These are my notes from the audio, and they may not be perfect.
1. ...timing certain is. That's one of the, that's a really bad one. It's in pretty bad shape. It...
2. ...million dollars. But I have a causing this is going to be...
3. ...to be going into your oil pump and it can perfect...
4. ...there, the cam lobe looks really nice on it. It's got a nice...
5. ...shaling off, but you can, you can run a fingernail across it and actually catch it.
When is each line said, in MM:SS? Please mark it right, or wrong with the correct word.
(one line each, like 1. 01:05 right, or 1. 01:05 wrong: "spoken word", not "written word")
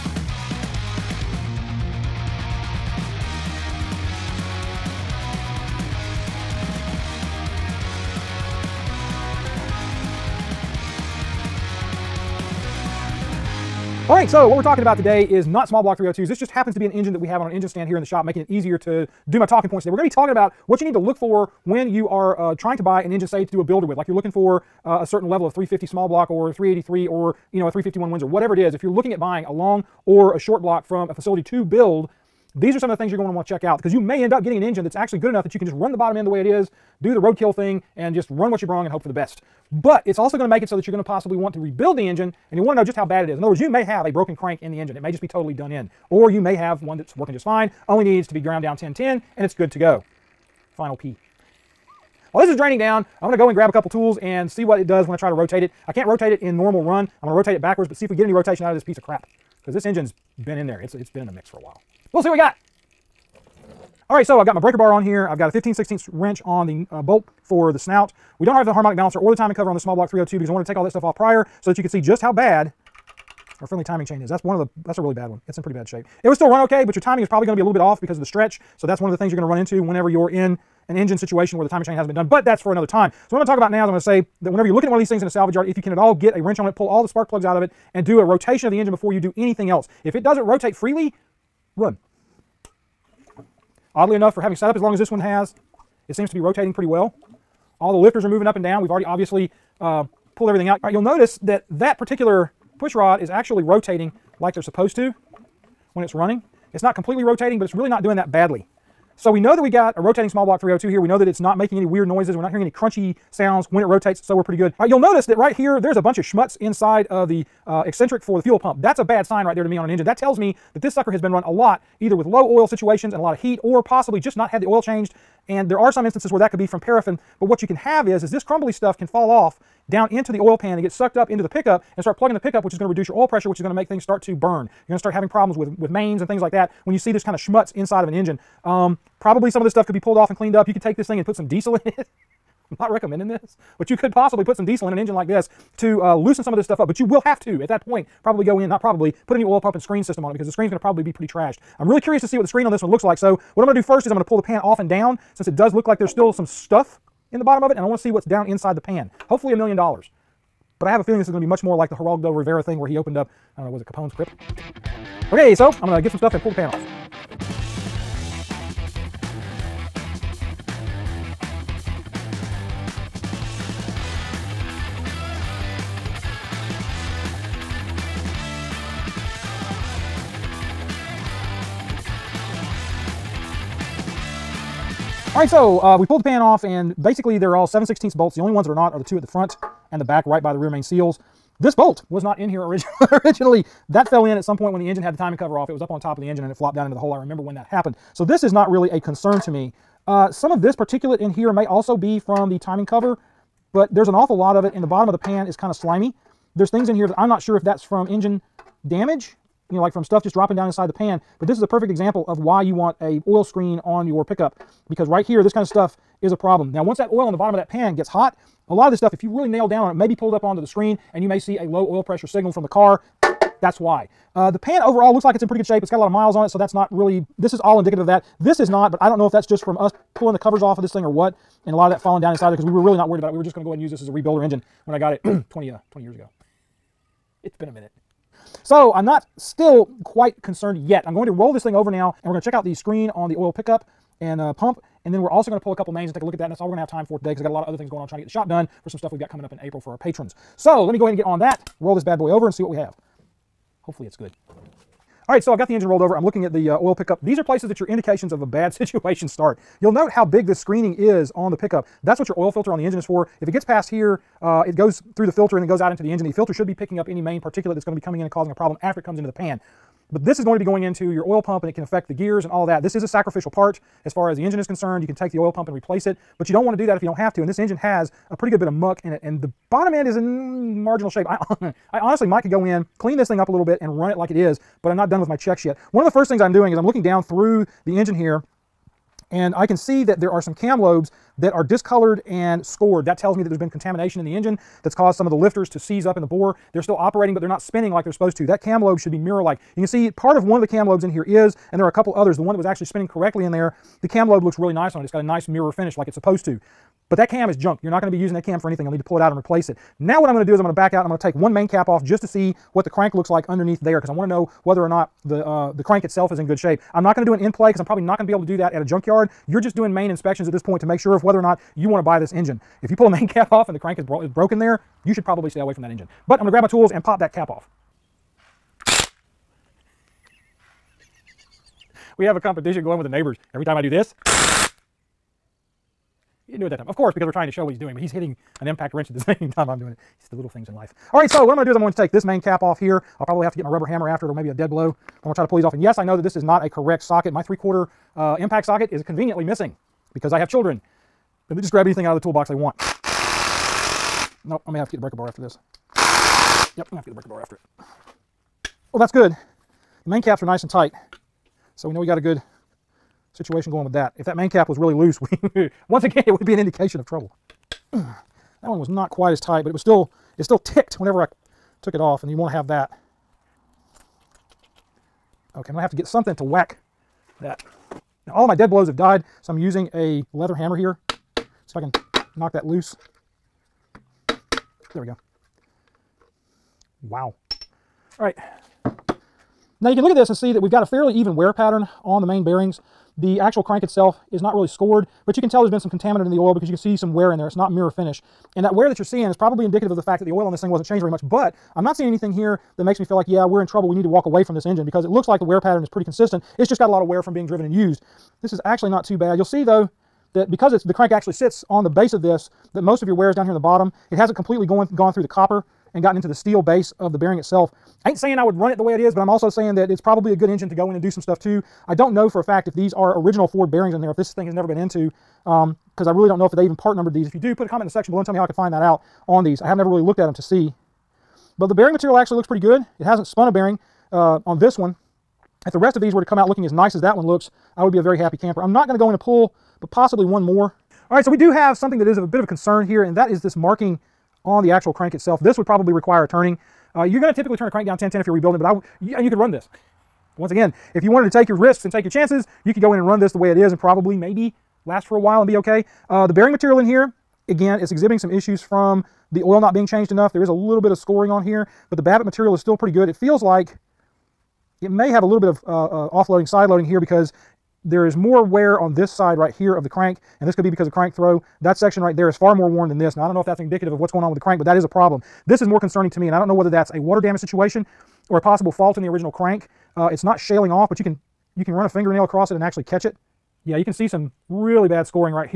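1. 01:13 wrong: "chain", not "certain"
2. 02:39 wrong: "feeling", not "causing"
3. 04:30 wrong: "affect", not "perfect"
4. 05:03 right
5. 08:00 right.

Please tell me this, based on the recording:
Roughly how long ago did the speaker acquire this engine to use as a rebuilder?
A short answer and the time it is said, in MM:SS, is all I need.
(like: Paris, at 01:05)
20 years, at 03:55.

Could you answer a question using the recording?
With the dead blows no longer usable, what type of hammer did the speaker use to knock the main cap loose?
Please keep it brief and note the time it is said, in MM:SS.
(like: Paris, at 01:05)
Leather hammer, at 06:20.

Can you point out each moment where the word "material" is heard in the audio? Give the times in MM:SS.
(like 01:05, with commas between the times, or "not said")
07:11, 07:36, 07:42.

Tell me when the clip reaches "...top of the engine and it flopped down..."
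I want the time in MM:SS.
03:15.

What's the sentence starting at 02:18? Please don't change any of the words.
Um, probably some of this stuff could be pulled off and cleaned up.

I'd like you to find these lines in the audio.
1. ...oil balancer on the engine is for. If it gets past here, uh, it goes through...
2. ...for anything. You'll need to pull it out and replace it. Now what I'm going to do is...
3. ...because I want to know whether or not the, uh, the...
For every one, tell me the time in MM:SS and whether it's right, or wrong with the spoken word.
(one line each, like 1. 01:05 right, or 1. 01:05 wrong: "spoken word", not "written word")
1. 04:22 wrong: "filter", not "balancer"
2. 05:08 right
3. 05:14 right.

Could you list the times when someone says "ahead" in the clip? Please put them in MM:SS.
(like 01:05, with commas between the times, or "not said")
03:53, 04:11.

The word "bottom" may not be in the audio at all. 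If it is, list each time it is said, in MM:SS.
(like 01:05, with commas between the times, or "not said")
00:35, 02:37, 03:24, 03:37, 04:39, 06:53.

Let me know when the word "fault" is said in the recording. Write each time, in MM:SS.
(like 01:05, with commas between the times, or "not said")
07:58.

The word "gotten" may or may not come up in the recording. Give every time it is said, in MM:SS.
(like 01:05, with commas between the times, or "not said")
06:56.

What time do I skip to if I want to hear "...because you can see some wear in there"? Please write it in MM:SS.
06:36.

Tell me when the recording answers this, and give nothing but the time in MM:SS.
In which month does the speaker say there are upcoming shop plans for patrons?
04:09.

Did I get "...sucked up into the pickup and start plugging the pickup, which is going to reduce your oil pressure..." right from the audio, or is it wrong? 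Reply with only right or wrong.
right.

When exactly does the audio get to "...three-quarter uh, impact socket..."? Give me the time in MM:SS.
05:47.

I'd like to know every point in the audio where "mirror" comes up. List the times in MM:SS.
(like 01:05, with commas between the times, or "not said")
04:59, 05:05, 06:37.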